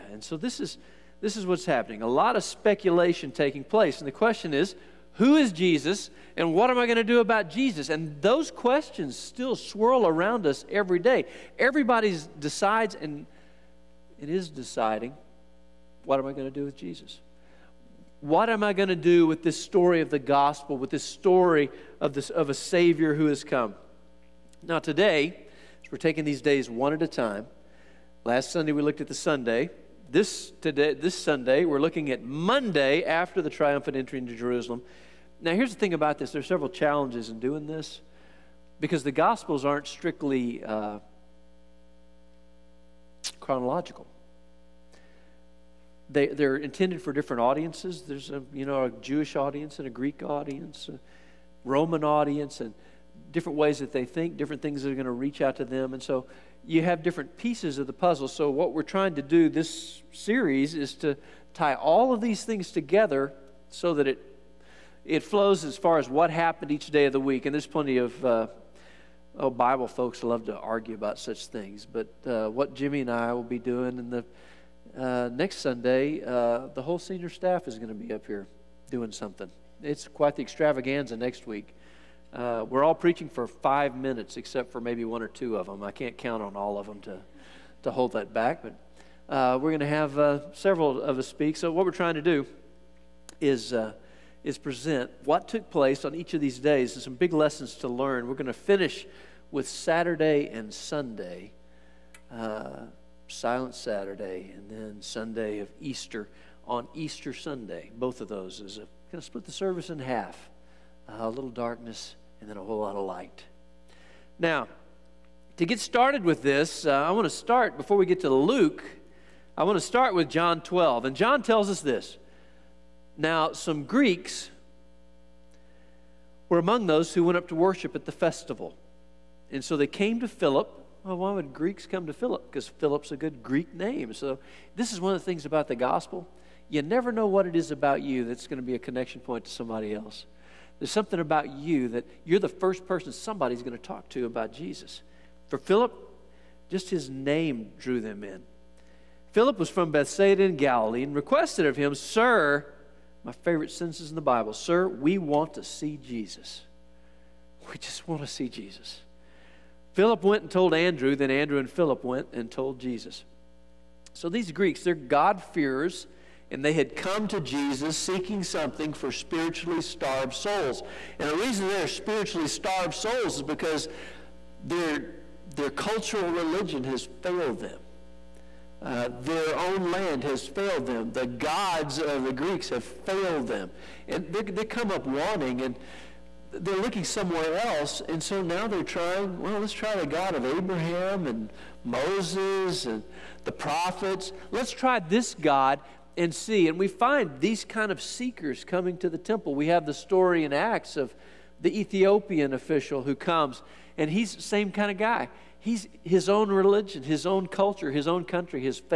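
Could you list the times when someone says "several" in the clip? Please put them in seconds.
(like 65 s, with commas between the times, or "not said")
36 s, 90 s.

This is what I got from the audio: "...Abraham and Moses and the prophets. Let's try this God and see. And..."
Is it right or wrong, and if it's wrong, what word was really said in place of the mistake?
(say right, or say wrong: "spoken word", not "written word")
right.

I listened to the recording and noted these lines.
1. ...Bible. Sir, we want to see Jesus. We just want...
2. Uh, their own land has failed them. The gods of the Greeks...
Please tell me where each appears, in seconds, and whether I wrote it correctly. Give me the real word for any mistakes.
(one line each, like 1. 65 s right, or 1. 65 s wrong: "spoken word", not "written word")
1. 154 s right
2. 178 s right.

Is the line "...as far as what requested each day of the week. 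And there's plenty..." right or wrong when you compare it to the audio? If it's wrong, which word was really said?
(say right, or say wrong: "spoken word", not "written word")
wrong: "happened", not "requested".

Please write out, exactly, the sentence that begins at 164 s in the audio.
So these Greeks, they're God-fearers, and they had come to Jesus seeking something for spiritually starved souls.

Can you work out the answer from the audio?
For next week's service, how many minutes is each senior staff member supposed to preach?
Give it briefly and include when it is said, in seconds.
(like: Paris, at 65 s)
5, at 83 s.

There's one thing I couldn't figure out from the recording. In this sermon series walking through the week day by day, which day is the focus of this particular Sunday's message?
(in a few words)
Monday.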